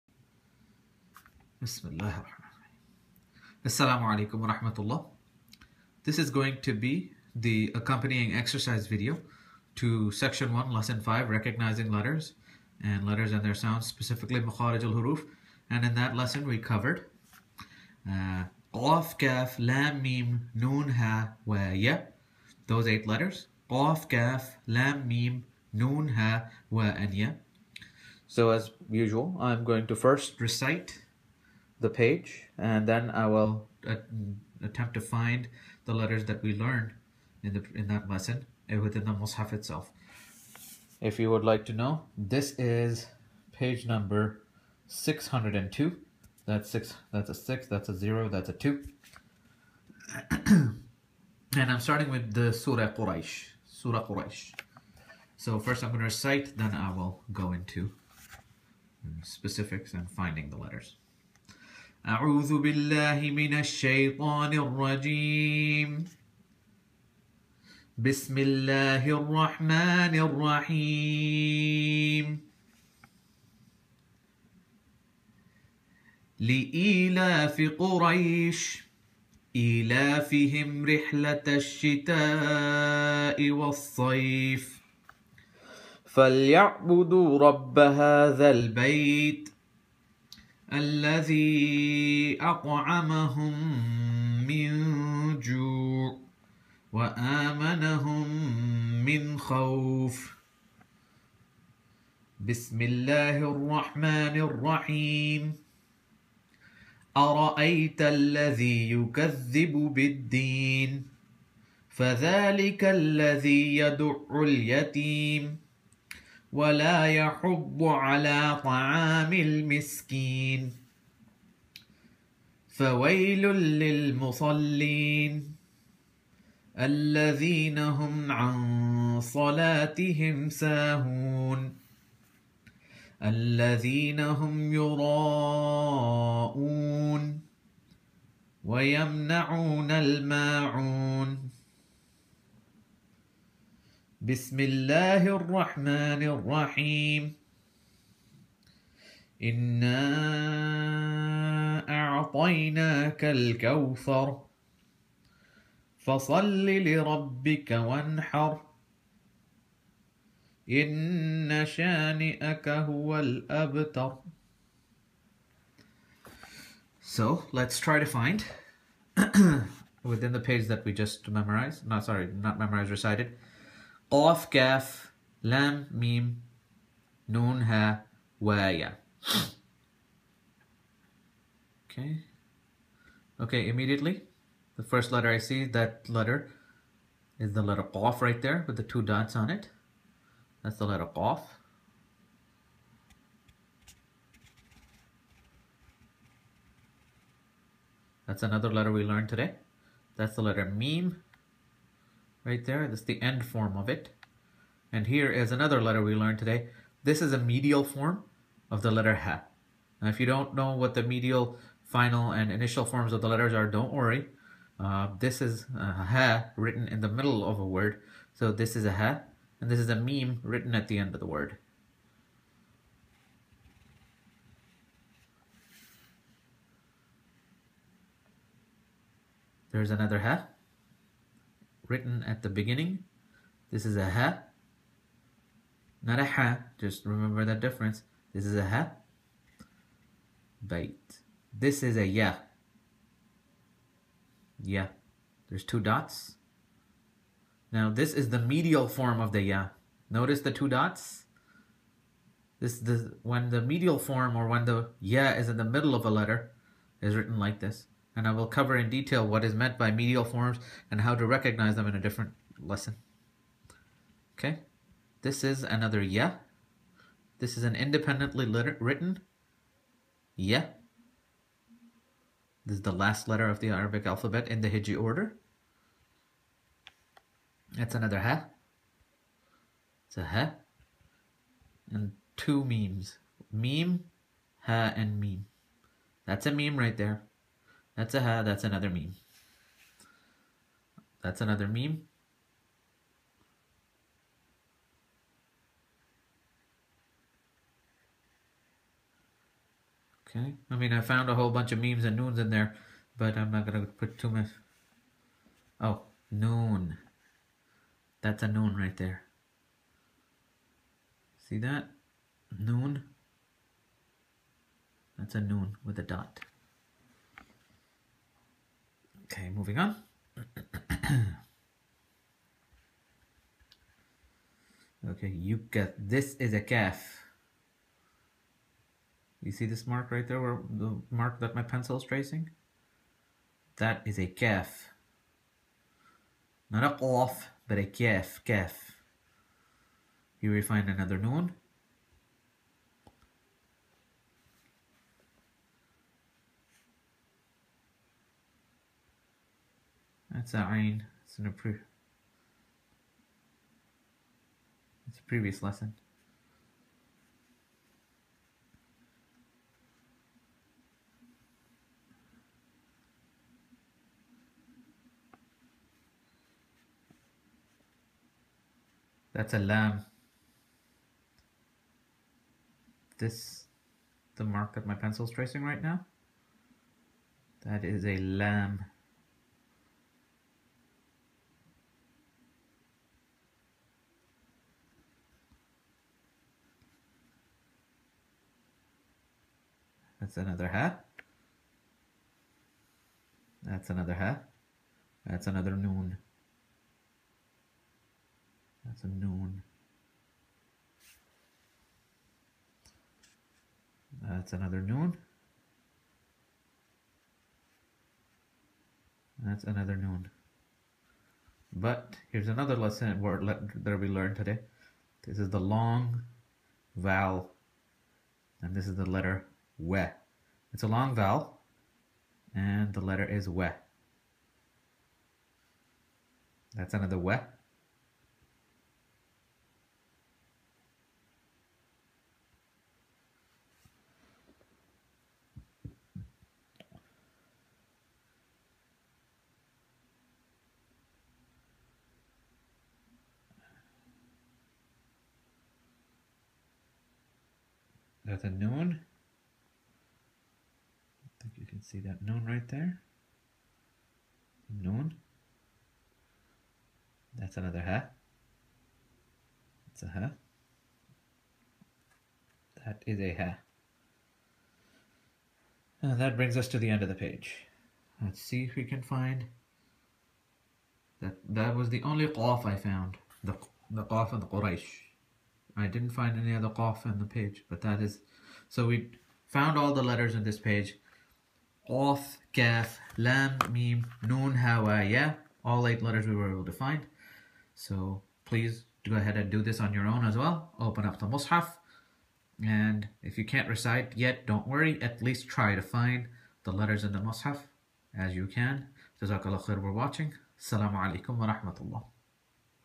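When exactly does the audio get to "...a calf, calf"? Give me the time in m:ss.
5:37.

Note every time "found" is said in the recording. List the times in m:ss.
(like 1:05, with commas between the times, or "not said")
5:01, 7:52, 7:59.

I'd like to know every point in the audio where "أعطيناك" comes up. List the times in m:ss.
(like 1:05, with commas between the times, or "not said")
2:32.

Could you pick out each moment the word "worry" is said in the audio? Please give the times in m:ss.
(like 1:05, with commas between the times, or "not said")
3:33, 8:14.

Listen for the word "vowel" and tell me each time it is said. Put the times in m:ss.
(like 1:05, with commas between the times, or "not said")
6:56, 7:01.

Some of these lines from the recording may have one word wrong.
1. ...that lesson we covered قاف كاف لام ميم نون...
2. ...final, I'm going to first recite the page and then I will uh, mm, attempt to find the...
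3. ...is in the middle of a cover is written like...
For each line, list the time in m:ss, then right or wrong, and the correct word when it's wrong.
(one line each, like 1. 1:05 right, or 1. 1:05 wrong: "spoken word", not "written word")
1. 0:15 right
2. 0:28 wrong: "usual", not "final"
3. 4:15 wrong: "letter", not "cover".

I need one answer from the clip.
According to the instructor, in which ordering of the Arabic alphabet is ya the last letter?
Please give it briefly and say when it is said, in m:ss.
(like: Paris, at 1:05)
hiji order, at 4:34.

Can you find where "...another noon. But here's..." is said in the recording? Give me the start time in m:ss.
6:49.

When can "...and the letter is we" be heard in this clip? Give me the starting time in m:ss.
7:02.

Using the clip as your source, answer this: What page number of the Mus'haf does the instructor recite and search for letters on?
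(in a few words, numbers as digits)
602.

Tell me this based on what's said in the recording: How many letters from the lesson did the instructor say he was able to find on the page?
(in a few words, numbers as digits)
8.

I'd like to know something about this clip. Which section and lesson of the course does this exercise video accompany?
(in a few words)
Section 1 lesson 5.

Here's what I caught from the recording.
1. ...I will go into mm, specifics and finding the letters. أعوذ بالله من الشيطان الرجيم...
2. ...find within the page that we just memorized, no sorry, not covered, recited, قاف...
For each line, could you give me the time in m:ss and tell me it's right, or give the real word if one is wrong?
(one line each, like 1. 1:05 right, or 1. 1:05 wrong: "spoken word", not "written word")
1. 0:56 right
2. 2:48 wrong: "memorized", not "covered".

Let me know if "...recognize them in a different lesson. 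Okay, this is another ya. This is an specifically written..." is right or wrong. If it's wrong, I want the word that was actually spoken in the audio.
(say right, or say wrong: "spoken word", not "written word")
wrong: "independently", not "specifically".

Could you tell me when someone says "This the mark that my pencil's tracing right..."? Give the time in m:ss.
6:13.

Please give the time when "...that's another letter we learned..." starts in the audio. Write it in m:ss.
3:18.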